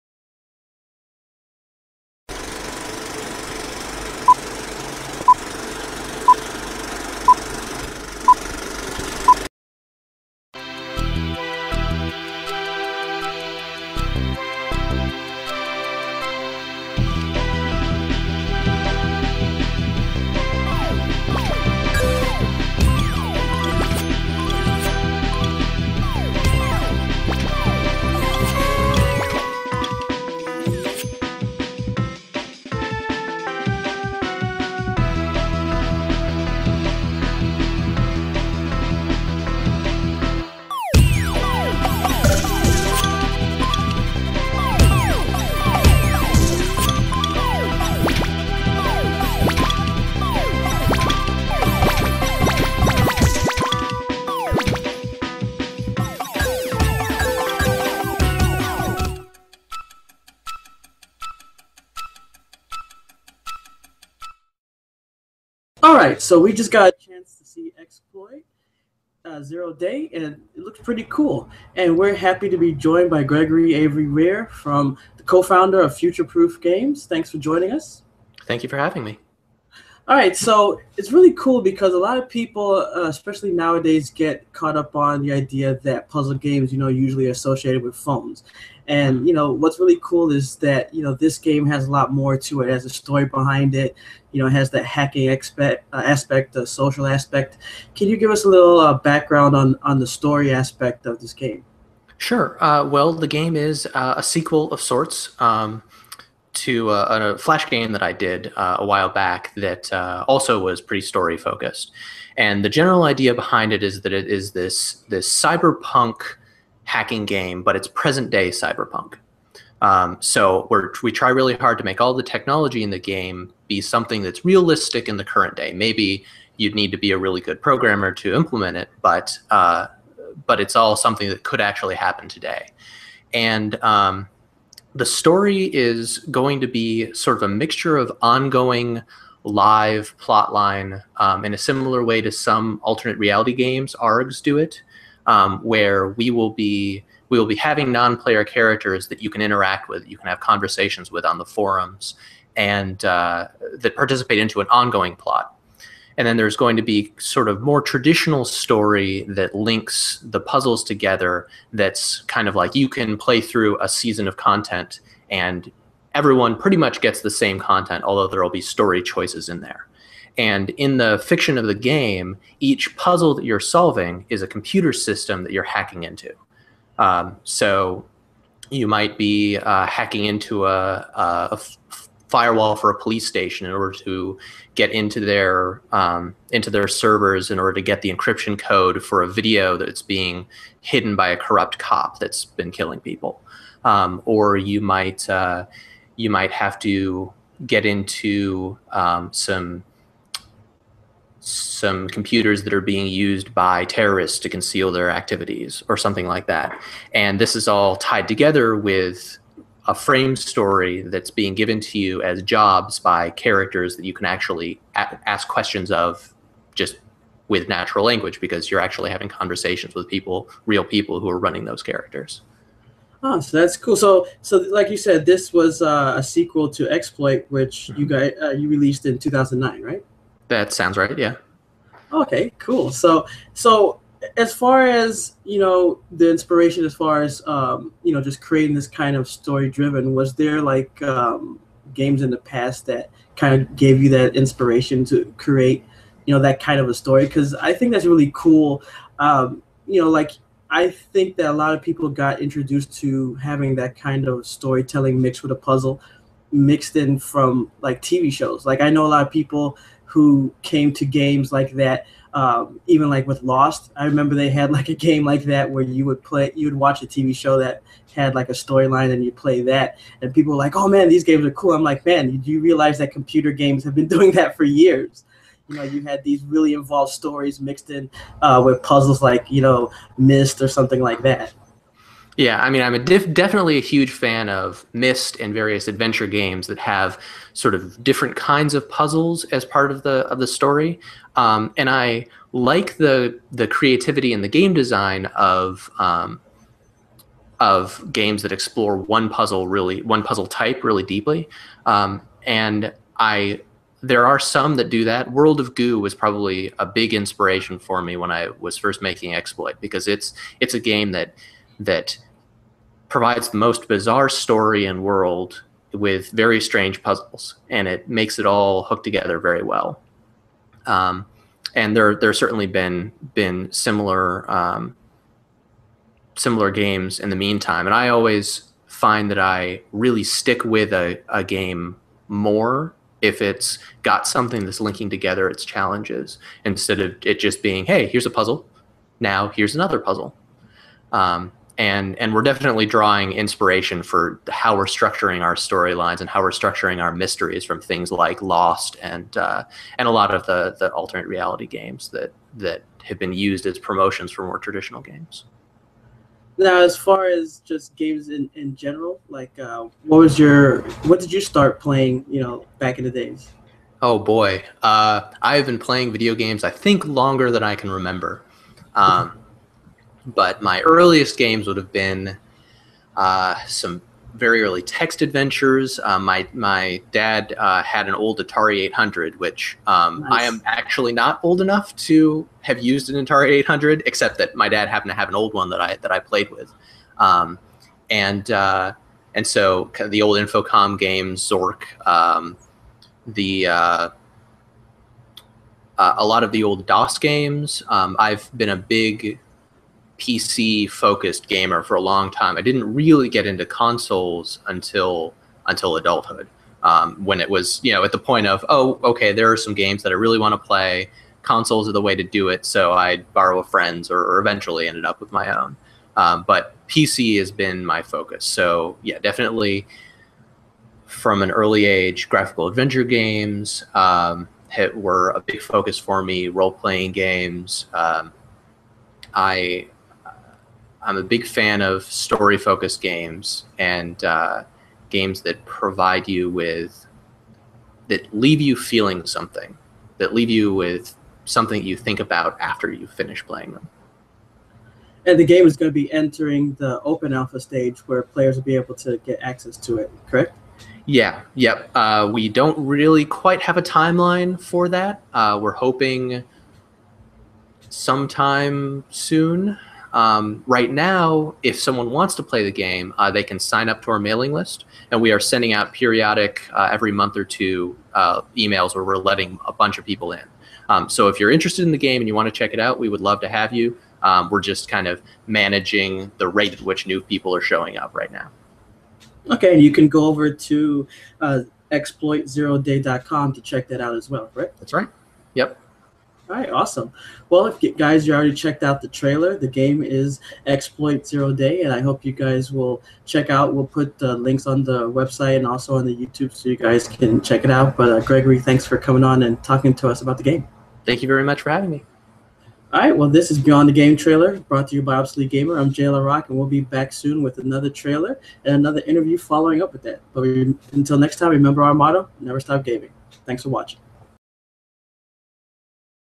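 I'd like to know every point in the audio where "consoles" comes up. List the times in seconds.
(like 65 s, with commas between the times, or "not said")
403 s, 411 s.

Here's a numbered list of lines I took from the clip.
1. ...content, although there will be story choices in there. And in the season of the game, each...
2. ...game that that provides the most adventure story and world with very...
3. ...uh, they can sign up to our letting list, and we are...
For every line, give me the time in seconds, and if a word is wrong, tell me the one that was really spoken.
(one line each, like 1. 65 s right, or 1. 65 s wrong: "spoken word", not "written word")
1. 167 s wrong: "fiction", not "season"
2. 310 s wrong: "bizarre", not "adventure"
3. 463 s wrong: "mailing", not "letting".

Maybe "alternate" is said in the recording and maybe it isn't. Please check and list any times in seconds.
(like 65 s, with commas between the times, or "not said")
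142 s, 350 s.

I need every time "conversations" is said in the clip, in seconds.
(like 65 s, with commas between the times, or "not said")
150 s, 219 s.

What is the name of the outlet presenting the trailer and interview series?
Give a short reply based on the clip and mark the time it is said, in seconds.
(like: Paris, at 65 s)
Obsolete Gamer, at 505 s.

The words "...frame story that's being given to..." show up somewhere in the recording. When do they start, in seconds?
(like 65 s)
209 s.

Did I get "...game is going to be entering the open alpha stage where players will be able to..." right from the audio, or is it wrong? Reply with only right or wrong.
right.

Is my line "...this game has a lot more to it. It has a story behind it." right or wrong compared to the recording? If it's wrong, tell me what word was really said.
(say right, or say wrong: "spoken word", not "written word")
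right.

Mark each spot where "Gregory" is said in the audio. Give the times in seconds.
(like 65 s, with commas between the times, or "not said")
73 s, 498 s.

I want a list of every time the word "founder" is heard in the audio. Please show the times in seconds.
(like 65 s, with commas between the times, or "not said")
75 s.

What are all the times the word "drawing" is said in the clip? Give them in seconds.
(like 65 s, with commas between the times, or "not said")
342 s.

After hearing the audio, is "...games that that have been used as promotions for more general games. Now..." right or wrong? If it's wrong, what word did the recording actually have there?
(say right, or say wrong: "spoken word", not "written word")
wrong: "traditional", not "general".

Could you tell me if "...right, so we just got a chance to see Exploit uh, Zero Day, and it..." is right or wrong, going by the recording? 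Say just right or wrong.
right.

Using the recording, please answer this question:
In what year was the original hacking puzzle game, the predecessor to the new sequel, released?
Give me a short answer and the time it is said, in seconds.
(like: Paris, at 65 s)
2009, at 229 s.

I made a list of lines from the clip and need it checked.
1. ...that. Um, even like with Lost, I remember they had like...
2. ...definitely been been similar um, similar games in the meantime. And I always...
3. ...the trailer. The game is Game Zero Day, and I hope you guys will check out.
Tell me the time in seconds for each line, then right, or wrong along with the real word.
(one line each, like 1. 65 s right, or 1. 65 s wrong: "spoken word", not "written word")
1. 261 s right
2. 322 s wrong: "certainly", not "definitely"
3. 489 s wrong: "Exploit", not "Game".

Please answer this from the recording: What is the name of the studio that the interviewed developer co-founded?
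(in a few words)
Future Proof Games.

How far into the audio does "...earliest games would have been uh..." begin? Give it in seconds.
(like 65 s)
370 s.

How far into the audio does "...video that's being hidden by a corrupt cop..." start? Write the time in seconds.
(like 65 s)
189 s.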